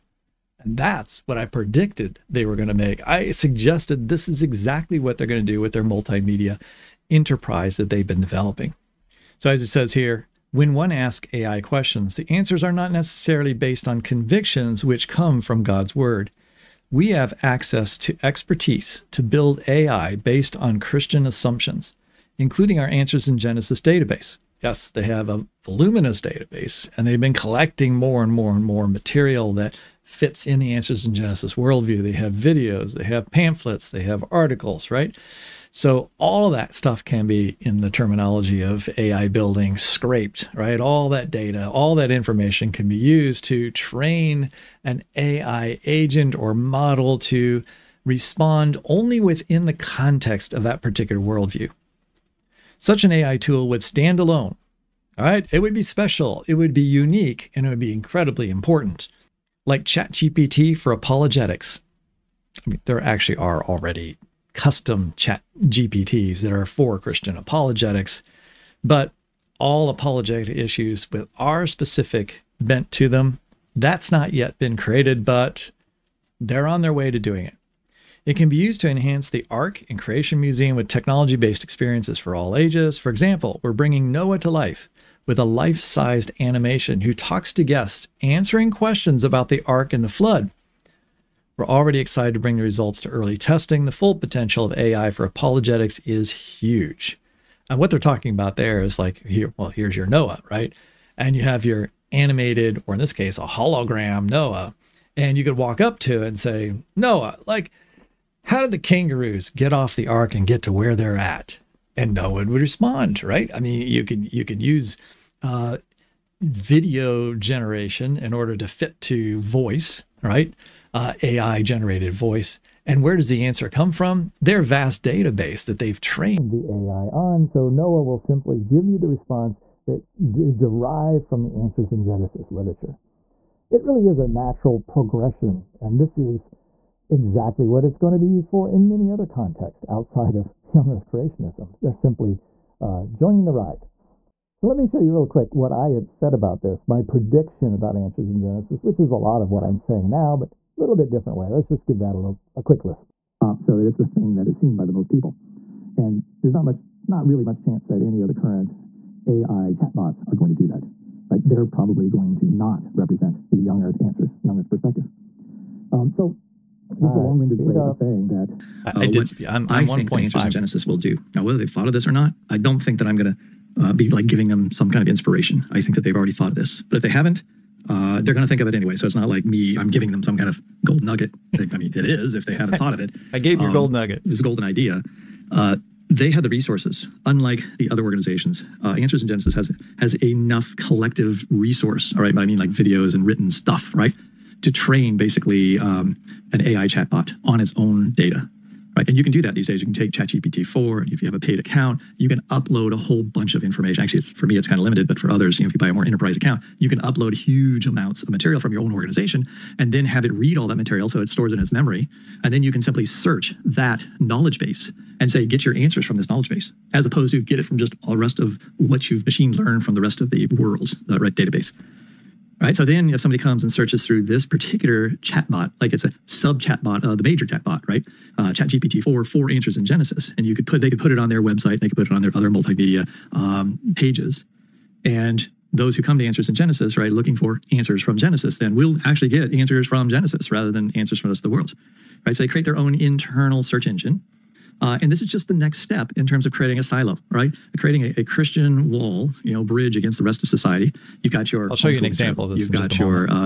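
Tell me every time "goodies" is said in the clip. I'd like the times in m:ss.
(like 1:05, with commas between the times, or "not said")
not said.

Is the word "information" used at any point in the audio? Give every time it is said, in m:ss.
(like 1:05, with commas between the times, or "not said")
0:42, 3:23.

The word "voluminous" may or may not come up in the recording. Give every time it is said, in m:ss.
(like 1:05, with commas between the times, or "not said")
0:25.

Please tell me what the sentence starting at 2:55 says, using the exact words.
I think that they've already thought of this.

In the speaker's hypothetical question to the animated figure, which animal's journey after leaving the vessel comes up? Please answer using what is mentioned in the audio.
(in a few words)
kangaroos.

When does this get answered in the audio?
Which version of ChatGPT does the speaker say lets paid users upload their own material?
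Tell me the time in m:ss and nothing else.
3:20.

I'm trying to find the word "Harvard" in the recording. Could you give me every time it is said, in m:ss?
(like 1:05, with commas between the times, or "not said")
not said.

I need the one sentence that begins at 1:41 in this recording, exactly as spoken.
And you have your animated, or in this case, a hologram Noah.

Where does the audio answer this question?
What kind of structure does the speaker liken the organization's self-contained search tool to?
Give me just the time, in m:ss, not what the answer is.
4:06.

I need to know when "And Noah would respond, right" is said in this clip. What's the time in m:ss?
1:51.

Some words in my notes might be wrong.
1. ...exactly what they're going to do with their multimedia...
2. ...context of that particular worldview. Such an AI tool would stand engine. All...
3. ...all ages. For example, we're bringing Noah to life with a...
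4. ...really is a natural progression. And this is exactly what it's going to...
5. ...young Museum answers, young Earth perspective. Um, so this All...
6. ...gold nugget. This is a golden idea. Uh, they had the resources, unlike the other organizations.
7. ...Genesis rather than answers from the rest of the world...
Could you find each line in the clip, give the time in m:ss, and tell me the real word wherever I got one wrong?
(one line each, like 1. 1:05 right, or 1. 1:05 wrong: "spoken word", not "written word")
1. 0:04 right
2. 0:49 wrong: "alone", not "engine"
3. 1:22 right
4. 2:13 right
5. 2:43 wrong: "Earth", not "Museum"
6. 3:03 right
7. 4:00 right.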